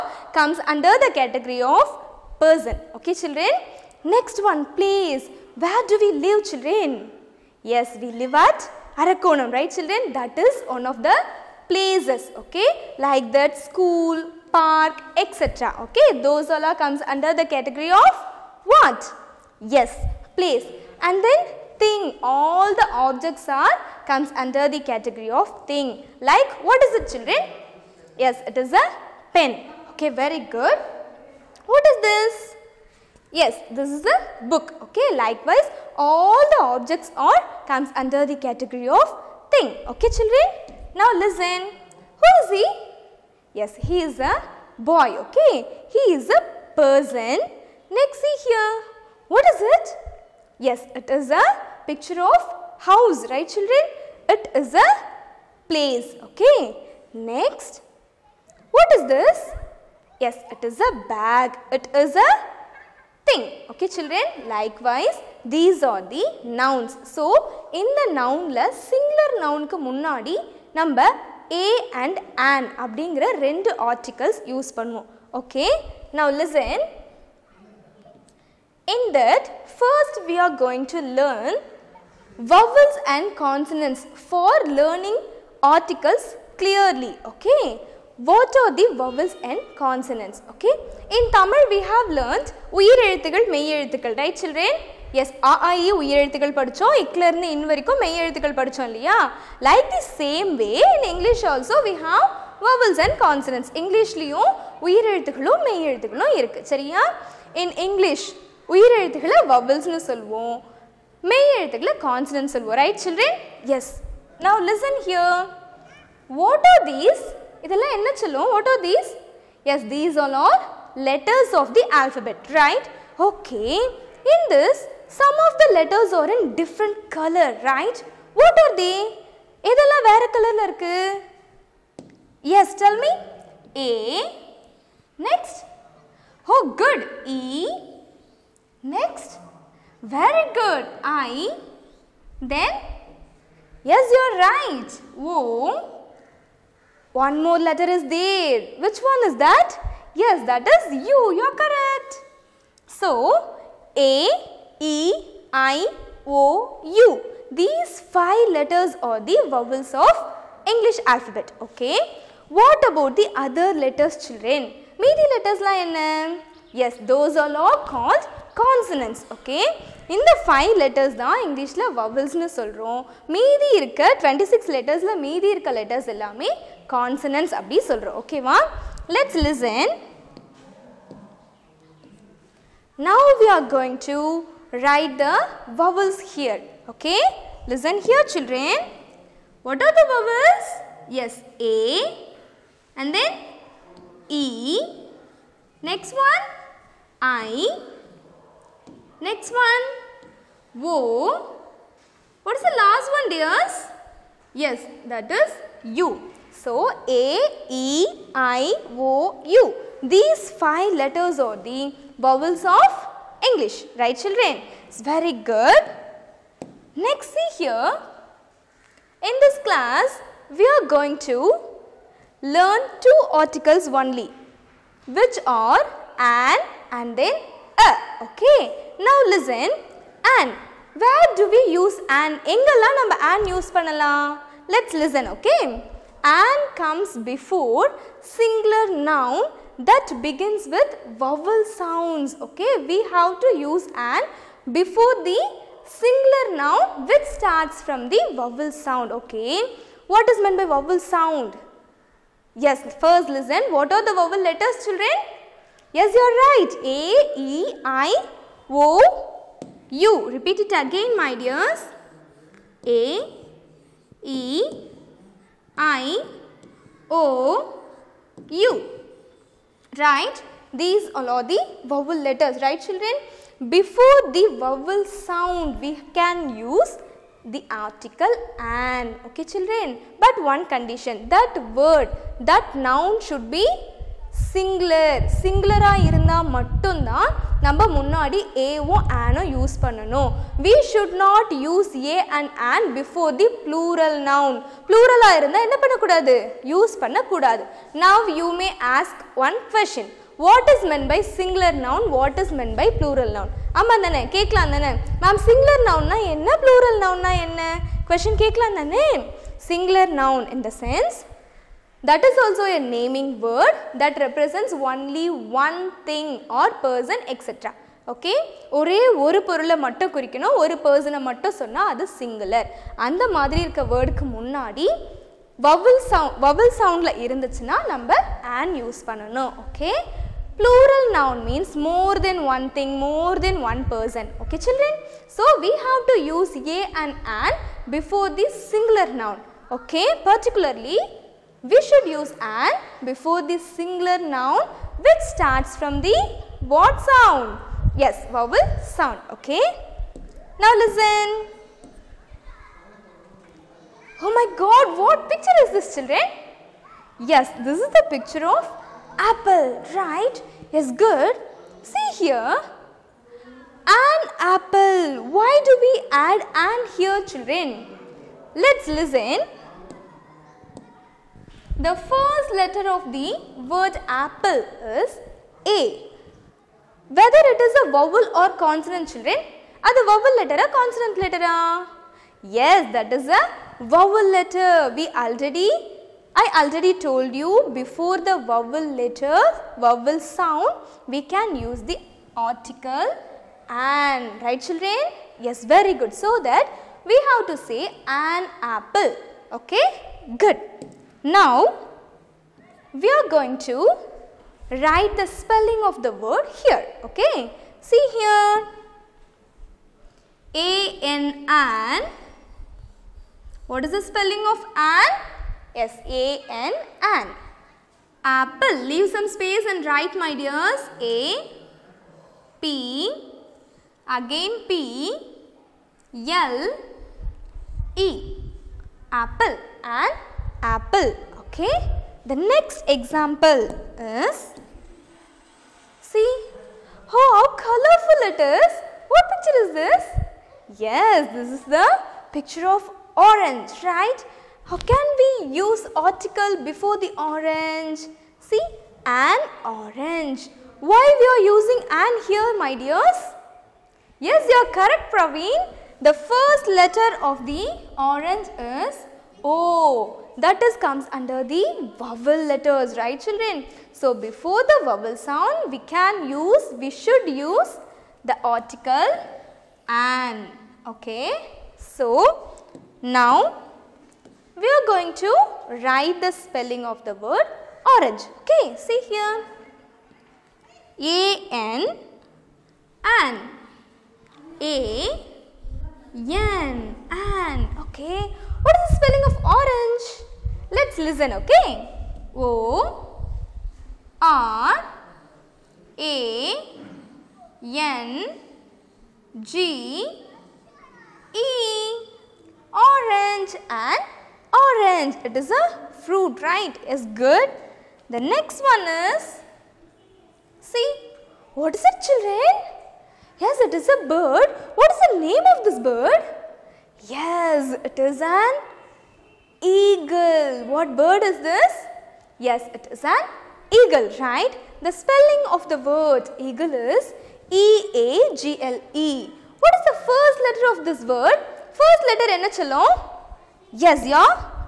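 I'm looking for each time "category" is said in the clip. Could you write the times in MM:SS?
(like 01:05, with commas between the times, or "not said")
00:01, 00:17, 00:24, 00:38.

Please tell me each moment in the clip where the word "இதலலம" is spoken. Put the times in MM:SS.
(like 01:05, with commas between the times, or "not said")
01:57, 02:09.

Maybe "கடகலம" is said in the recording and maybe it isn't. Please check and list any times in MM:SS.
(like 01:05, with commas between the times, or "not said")
05:04, 05:08.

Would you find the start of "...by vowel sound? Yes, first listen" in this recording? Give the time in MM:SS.
04:10.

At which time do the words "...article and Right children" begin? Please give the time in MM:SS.
06:32.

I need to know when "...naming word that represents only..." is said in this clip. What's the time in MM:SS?
05:12.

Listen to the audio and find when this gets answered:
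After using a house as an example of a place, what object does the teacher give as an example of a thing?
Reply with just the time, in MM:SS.
01:01.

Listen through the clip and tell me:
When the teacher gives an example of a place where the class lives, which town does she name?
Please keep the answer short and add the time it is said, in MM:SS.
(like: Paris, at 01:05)
Arakkonam, at 00:09.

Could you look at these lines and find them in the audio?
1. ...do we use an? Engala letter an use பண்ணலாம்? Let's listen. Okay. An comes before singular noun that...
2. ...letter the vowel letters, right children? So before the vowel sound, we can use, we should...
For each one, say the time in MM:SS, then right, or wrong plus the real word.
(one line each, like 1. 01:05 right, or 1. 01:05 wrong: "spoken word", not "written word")
1. 03:51 wrong: "number", not "letter"
2. 07:41 wrong: "under", not "letter".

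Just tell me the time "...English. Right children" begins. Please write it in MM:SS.
03:33.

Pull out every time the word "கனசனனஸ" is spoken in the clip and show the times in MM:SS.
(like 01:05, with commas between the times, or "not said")
01:43, 01:52, 02:48, 02:56.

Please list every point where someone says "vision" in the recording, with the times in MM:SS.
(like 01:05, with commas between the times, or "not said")
not said.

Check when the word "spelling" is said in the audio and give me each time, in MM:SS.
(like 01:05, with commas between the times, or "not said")
06:45, 06:54, 07:56, 08:08, 08:44.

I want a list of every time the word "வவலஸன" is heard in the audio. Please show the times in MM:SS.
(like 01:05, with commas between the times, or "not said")
01:49, 02:51.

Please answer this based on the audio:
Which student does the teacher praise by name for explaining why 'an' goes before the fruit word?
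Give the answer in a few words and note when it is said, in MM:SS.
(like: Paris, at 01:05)
Praveen, at 07:35.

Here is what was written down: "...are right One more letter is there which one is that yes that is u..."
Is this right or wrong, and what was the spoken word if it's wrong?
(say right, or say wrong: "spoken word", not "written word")
right.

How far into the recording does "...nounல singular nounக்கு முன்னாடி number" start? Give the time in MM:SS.
01:08.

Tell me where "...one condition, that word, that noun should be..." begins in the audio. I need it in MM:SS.
04:40.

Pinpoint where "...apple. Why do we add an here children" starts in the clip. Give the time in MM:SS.
06:04.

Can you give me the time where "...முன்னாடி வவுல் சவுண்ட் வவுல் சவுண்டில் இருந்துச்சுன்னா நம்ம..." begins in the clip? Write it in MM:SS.
05:24.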